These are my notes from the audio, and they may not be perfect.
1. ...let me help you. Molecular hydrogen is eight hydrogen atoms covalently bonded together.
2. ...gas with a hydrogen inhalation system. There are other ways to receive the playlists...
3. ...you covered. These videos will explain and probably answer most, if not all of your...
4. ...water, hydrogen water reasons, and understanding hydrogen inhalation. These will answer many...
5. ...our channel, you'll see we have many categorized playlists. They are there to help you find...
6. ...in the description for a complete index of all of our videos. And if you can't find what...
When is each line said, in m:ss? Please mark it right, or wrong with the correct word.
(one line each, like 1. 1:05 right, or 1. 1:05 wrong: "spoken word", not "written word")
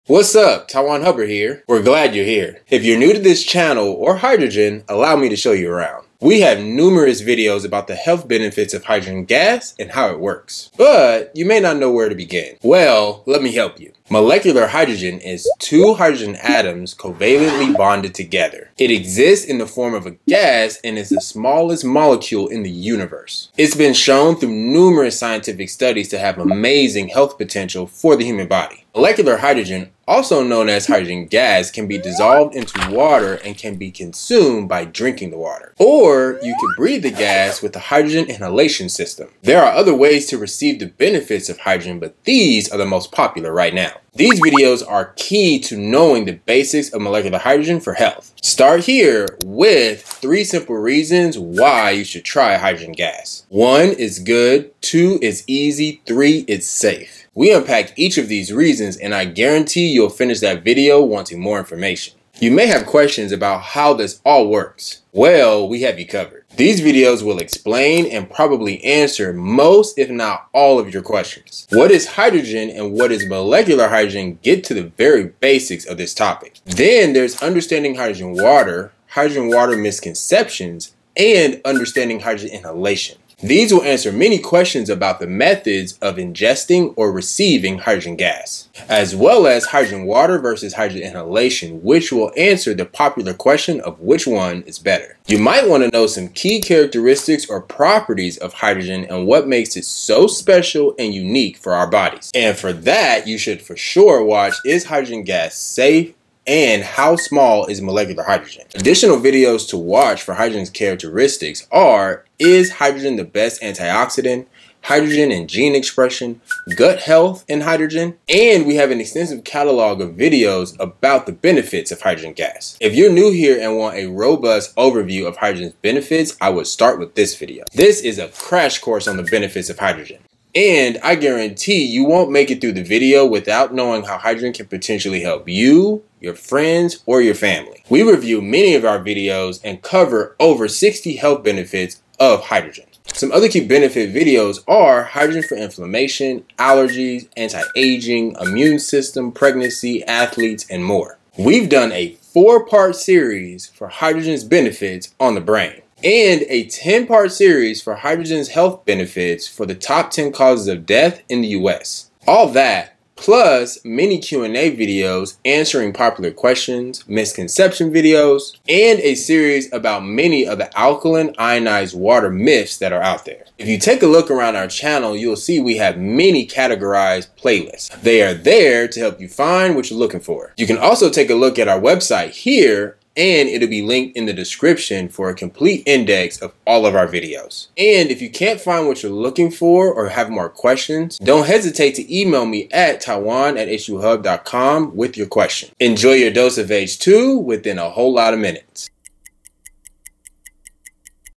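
1. 0:13 wrong: "two", not "eight"
2. 0:37 wrong: "benefits", not "playlists"
3. 1:05 right
4. 1:18 wrong: "misconceptions", not "reasons"
5. 2:54 right
6. 3:04 right.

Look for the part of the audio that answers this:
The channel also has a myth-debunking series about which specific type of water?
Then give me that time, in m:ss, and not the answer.
2:50.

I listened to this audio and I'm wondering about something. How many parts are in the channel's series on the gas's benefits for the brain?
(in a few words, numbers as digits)
4.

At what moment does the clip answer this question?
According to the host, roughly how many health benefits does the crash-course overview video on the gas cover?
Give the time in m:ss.
2:20.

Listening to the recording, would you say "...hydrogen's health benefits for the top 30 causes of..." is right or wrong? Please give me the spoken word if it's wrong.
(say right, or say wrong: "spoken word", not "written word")
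wrong: "10", not "30".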